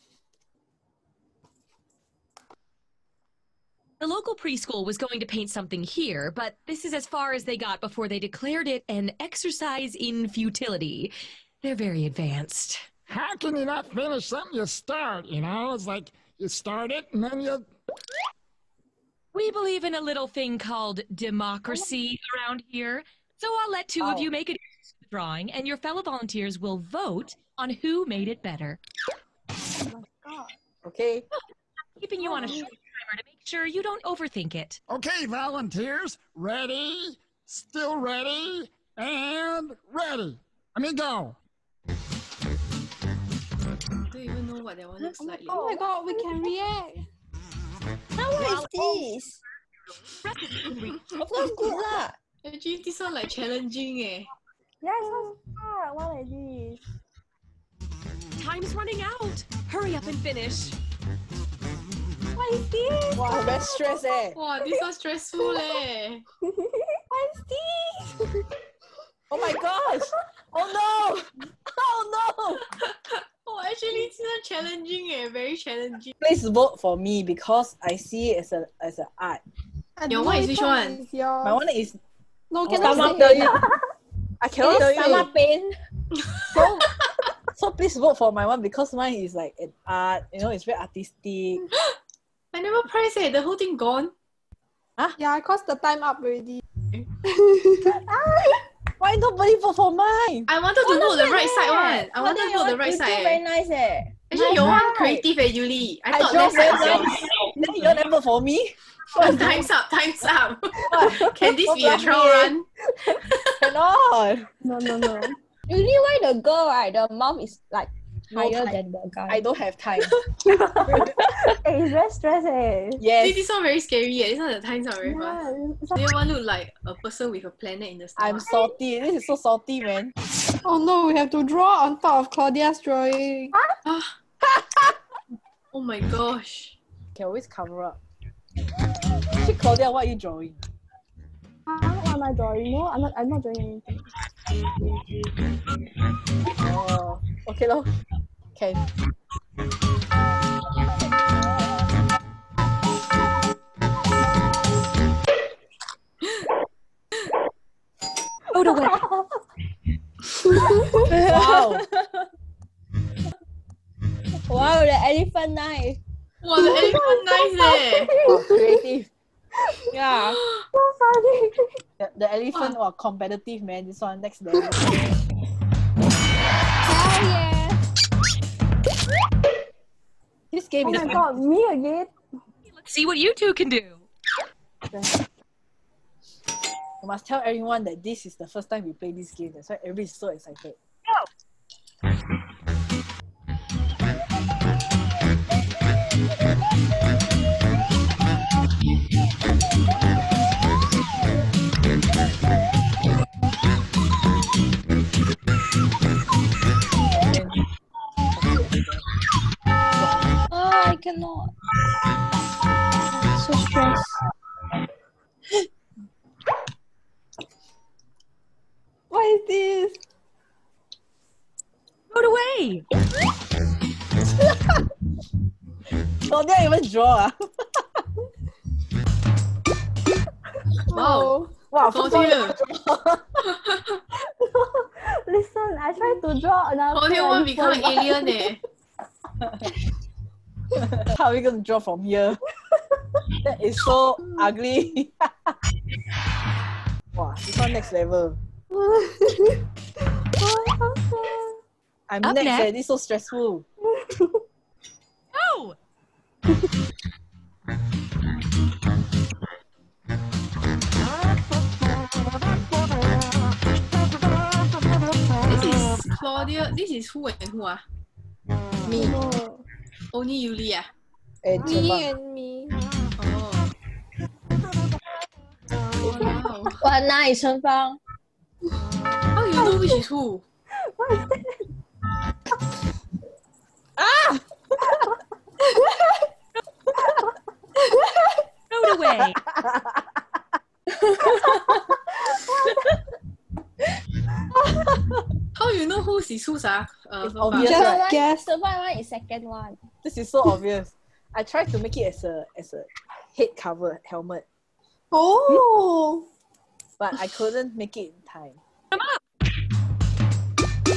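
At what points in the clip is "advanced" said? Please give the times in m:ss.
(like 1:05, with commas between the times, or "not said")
0:12.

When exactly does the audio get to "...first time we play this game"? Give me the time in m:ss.
3:08.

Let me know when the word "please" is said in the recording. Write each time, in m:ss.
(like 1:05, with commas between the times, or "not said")
1:16, 1:27.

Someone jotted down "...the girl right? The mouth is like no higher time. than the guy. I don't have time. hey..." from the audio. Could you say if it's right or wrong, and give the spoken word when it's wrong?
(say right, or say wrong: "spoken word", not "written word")
right.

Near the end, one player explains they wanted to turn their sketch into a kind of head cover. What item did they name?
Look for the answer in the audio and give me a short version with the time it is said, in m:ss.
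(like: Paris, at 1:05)
Helmet, at 5:04.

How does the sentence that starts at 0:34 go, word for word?
Okay, volunteers, ready, still ready, and ready.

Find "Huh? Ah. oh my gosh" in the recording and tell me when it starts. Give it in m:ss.
2:13.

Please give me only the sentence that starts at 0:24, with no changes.
of you make a drawing, and your fellow volunteers will vote on who made it better.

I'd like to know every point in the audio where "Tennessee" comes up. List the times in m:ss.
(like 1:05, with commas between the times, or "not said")
not said.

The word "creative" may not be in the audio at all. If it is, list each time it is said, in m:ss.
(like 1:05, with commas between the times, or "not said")
1:44, 2:48.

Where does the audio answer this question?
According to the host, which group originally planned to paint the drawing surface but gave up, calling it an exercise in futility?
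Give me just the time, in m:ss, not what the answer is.
0:04.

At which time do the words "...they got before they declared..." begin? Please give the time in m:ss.
0:07.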